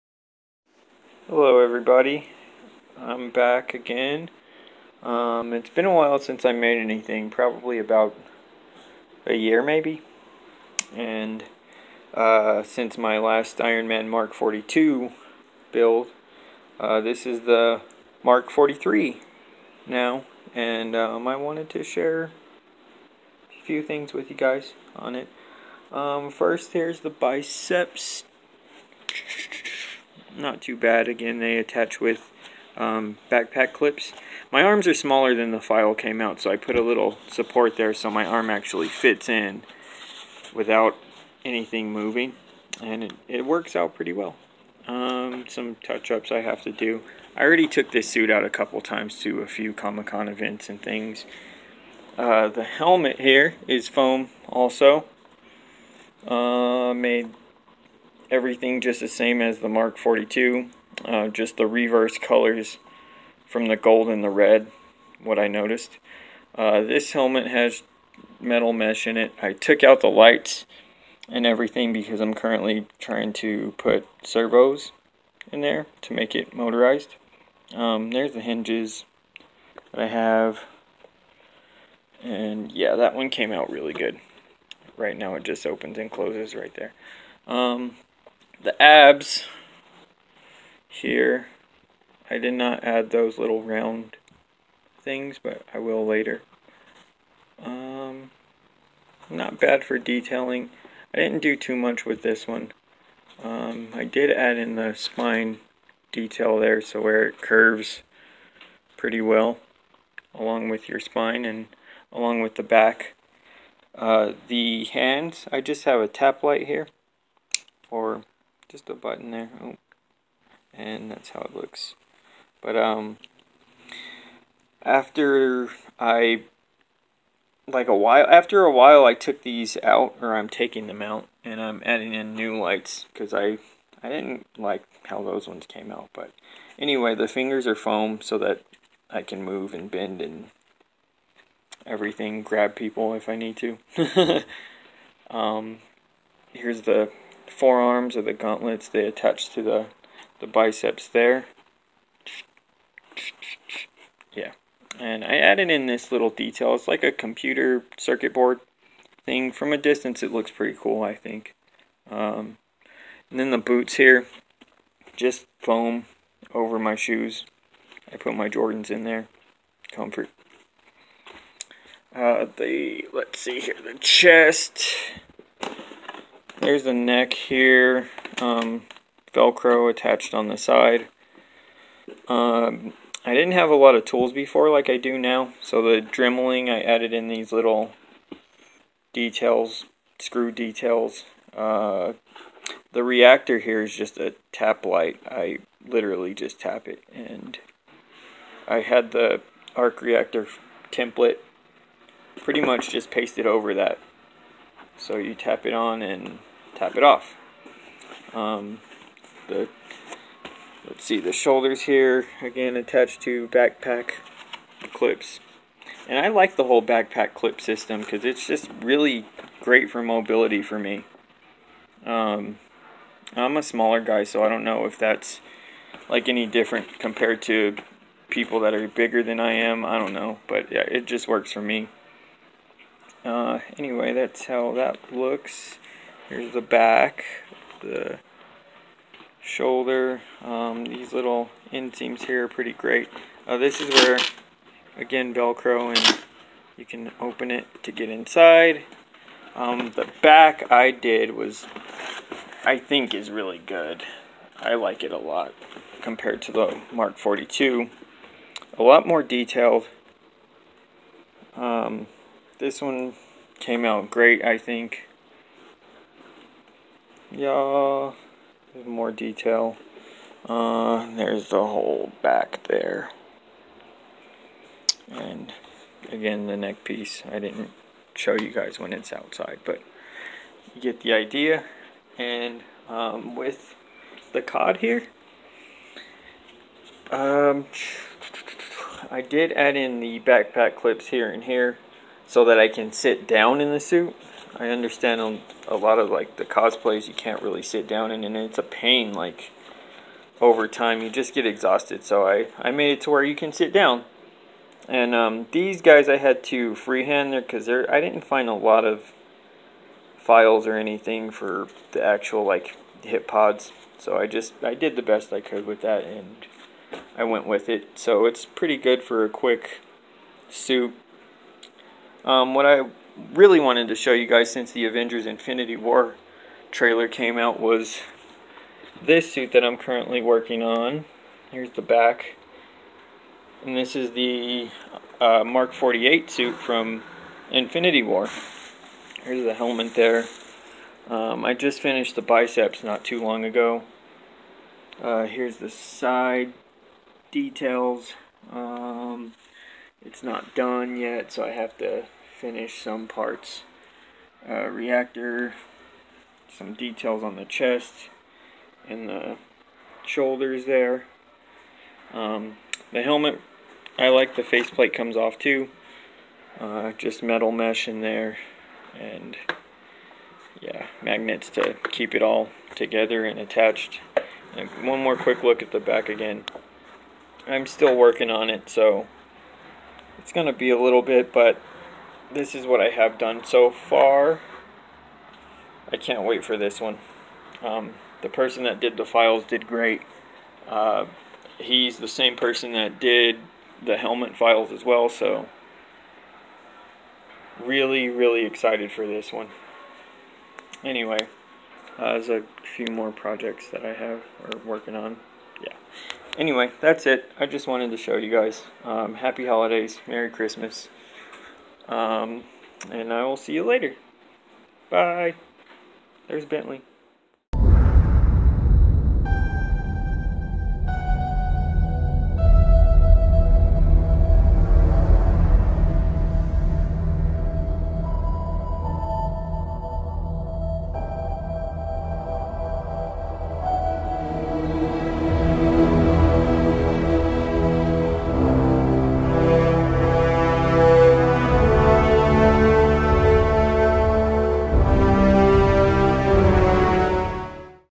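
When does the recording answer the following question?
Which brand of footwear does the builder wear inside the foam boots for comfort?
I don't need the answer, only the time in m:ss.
2:48.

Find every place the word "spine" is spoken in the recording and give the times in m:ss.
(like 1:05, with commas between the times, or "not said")
1:44, 1:50.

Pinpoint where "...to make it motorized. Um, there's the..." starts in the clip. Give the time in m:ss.
1:16.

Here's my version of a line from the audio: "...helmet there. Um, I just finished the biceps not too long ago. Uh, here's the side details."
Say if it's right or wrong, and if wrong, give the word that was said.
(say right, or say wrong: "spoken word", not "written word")
right.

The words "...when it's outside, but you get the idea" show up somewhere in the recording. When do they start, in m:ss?
4:38.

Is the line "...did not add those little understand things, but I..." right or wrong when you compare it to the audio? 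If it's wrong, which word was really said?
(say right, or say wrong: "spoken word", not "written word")
wrong: "round", not "understand".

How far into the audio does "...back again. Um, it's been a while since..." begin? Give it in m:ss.
0:03.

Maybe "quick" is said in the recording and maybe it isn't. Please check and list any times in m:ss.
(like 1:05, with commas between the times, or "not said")
5:19, 6:15.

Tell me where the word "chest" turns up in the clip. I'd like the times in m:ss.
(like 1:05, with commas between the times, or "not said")
2:53, 5:57.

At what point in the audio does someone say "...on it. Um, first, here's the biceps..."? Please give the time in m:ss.
0:24.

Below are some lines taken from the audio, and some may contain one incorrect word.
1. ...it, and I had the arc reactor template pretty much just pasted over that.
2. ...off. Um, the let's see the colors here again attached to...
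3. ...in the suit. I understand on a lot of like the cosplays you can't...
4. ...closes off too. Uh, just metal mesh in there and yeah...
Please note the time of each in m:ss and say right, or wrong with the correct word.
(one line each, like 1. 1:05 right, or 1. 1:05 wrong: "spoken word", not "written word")
1. 3:16 right
2. 3:27 wrong: "shoulders", not "colors"
3. 4:53 right
4. 6:04 wrong: "comes", not "closes".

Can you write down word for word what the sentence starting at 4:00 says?
Um, these little inseams here are pretty great.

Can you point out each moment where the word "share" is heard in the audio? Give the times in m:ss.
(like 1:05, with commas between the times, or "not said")
0:21.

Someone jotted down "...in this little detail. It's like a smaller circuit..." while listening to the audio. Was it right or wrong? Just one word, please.
wrong.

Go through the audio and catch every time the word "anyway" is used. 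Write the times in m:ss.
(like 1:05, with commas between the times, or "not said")
2:16, 3:53, 6:40, 6:46.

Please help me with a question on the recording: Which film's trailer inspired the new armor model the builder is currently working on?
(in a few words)
Avengers Infinity War.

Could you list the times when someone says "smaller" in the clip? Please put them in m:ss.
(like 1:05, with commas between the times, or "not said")
0:34, 3:43.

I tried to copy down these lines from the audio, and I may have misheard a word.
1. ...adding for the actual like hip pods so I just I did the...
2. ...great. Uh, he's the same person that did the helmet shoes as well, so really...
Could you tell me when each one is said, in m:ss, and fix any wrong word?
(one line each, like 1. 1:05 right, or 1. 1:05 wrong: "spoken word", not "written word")
1. 5:10 wrong: "anything", not "adding"
2. 6:29 wrong: "files", not "shoes".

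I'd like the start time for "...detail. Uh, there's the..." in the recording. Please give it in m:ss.
4:29.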